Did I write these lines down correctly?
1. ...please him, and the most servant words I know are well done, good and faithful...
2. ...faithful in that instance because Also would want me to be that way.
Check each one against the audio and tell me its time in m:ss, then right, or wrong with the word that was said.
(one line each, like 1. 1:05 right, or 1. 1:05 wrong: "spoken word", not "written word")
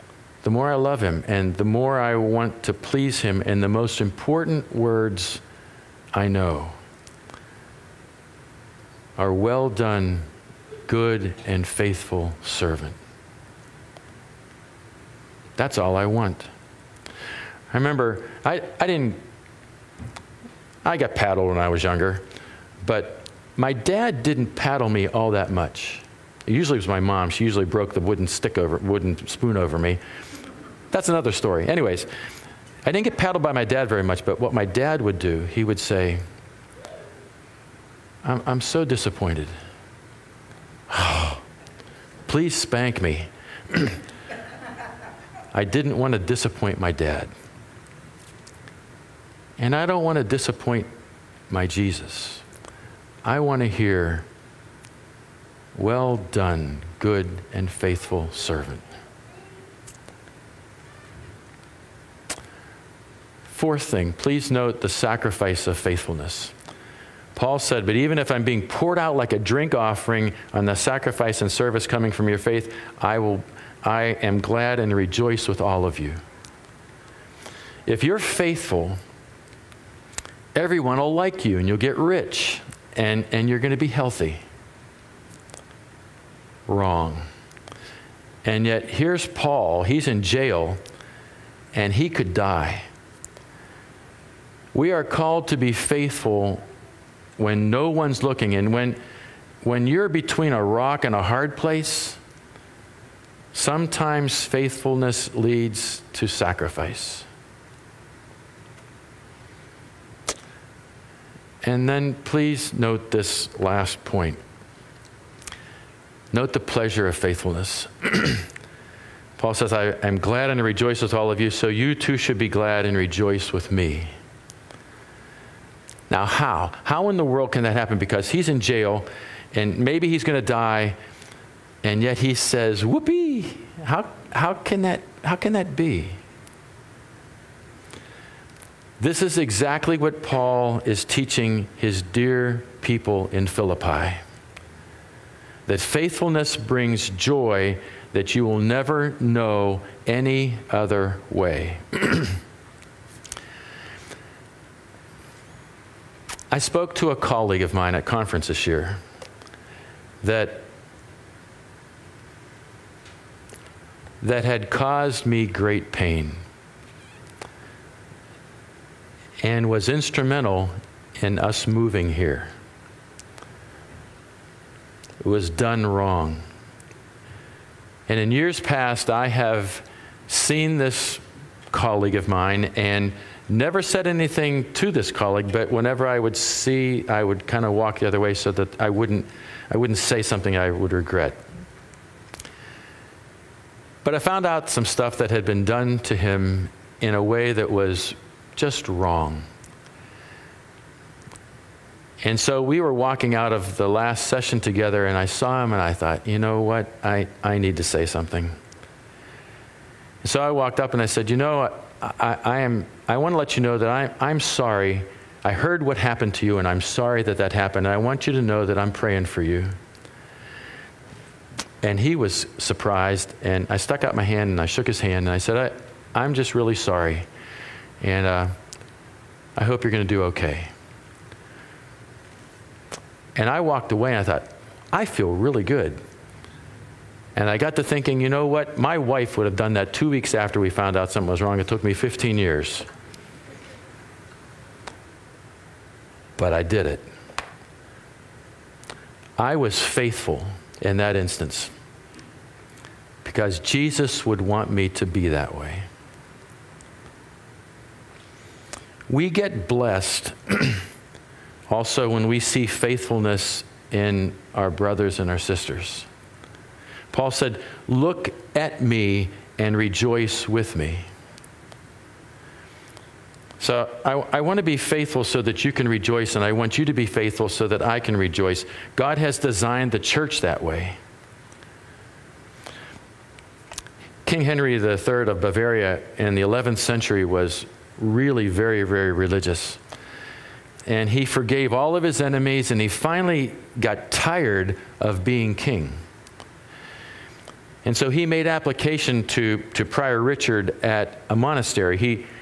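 1. 0:02 wrong: "important", not "servant"
2. 4:09 wrong: "Jesus", not "Also".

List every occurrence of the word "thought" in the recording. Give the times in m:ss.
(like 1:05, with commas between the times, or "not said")
3:25, 3:54.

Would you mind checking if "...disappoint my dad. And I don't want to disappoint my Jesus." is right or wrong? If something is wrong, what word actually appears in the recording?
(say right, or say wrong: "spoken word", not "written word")
right.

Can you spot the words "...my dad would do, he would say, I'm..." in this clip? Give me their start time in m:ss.
0:34.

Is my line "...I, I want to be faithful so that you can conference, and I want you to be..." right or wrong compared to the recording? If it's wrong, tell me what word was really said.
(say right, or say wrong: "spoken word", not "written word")
wrong: "rejoice", not "conference".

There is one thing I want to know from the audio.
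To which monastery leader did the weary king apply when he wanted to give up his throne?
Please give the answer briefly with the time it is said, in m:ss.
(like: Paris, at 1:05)
Prior Richard, at 4:59.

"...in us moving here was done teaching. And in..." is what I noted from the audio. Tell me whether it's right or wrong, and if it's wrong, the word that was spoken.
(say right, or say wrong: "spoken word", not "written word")
wrong: "wrong", not "teaching".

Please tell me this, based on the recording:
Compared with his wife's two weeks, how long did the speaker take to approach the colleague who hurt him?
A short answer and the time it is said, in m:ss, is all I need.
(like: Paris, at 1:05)
15 years, at 4:01.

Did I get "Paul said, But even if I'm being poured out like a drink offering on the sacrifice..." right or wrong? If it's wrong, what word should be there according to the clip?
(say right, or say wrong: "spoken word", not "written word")
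right.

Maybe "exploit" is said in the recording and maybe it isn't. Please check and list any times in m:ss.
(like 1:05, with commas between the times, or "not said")
not said.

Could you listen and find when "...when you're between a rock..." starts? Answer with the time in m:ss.
1:39.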